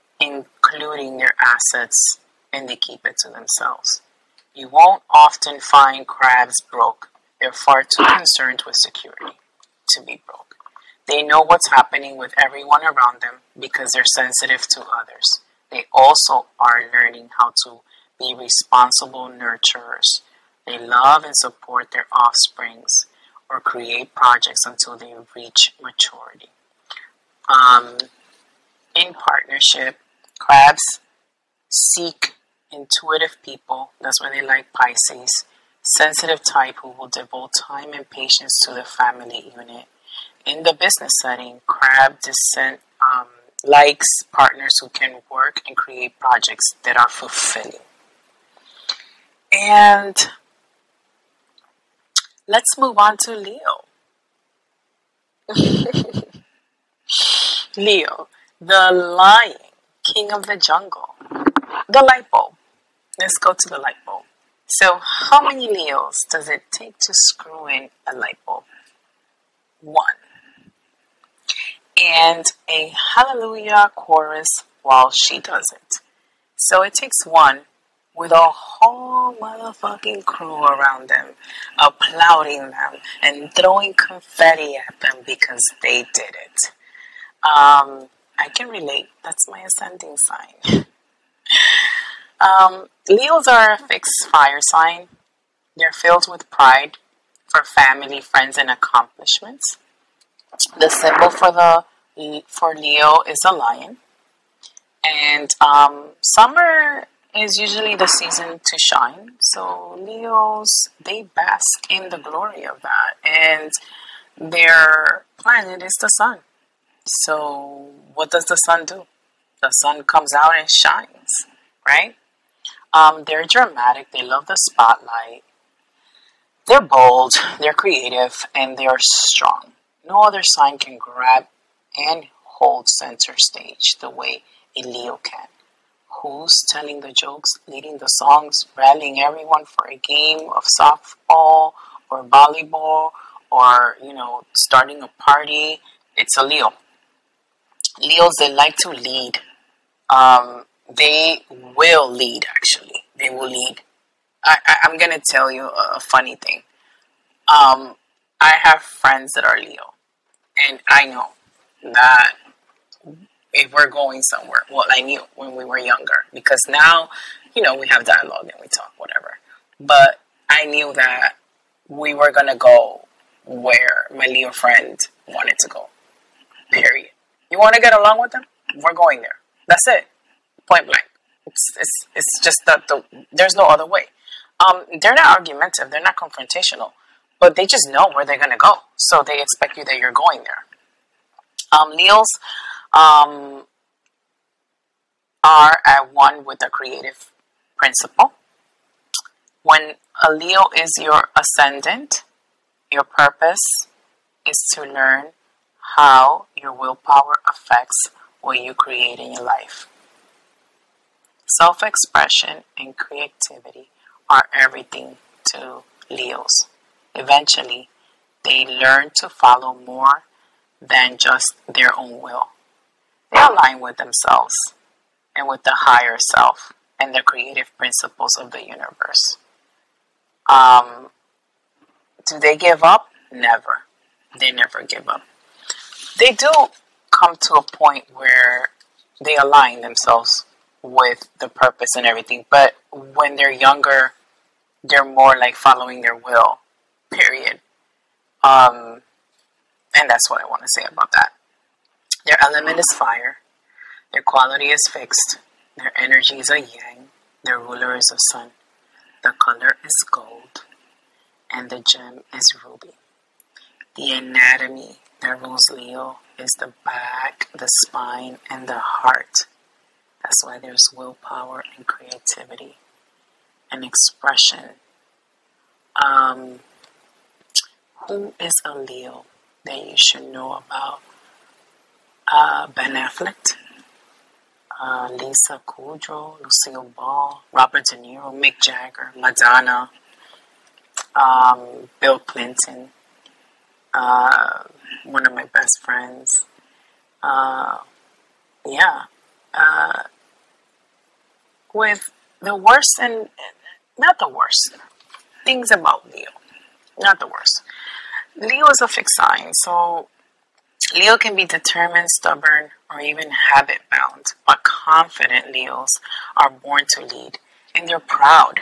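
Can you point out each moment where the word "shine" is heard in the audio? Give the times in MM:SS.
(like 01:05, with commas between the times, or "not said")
01:48, 02:00.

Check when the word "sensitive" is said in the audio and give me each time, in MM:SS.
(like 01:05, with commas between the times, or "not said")
00:14, 00:35.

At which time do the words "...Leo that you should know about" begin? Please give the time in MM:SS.
04:38.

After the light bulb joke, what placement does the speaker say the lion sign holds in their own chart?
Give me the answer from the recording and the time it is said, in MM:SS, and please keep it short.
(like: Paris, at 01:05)
Ascending sign, at 01:29.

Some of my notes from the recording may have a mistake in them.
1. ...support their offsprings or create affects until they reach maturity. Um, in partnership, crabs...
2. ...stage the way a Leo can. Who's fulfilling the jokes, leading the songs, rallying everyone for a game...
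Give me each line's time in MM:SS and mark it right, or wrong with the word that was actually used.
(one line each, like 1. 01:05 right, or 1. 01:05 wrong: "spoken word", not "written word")
1. 00:21 wrong: "projects", not "affects"
2. 02:13 wrong: "telling", not "fulfilling".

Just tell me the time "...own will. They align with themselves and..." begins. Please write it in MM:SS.
03:41.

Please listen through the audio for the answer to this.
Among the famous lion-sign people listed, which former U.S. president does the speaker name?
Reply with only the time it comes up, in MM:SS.
04:51.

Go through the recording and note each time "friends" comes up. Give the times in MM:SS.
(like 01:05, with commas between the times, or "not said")
01:38, 02:38, 02:54, 04:55.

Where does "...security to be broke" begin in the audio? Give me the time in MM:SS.
00:08.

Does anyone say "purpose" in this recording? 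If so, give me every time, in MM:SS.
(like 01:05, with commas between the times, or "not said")
03:23, 04:01.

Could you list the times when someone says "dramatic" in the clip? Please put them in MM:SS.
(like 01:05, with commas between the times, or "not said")
02:03.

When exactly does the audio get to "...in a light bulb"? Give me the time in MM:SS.
01:07.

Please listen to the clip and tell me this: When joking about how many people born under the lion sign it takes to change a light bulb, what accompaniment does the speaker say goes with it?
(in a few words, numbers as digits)
A hallelujah chorus.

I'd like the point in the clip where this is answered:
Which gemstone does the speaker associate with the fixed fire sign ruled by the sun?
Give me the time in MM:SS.
04:22.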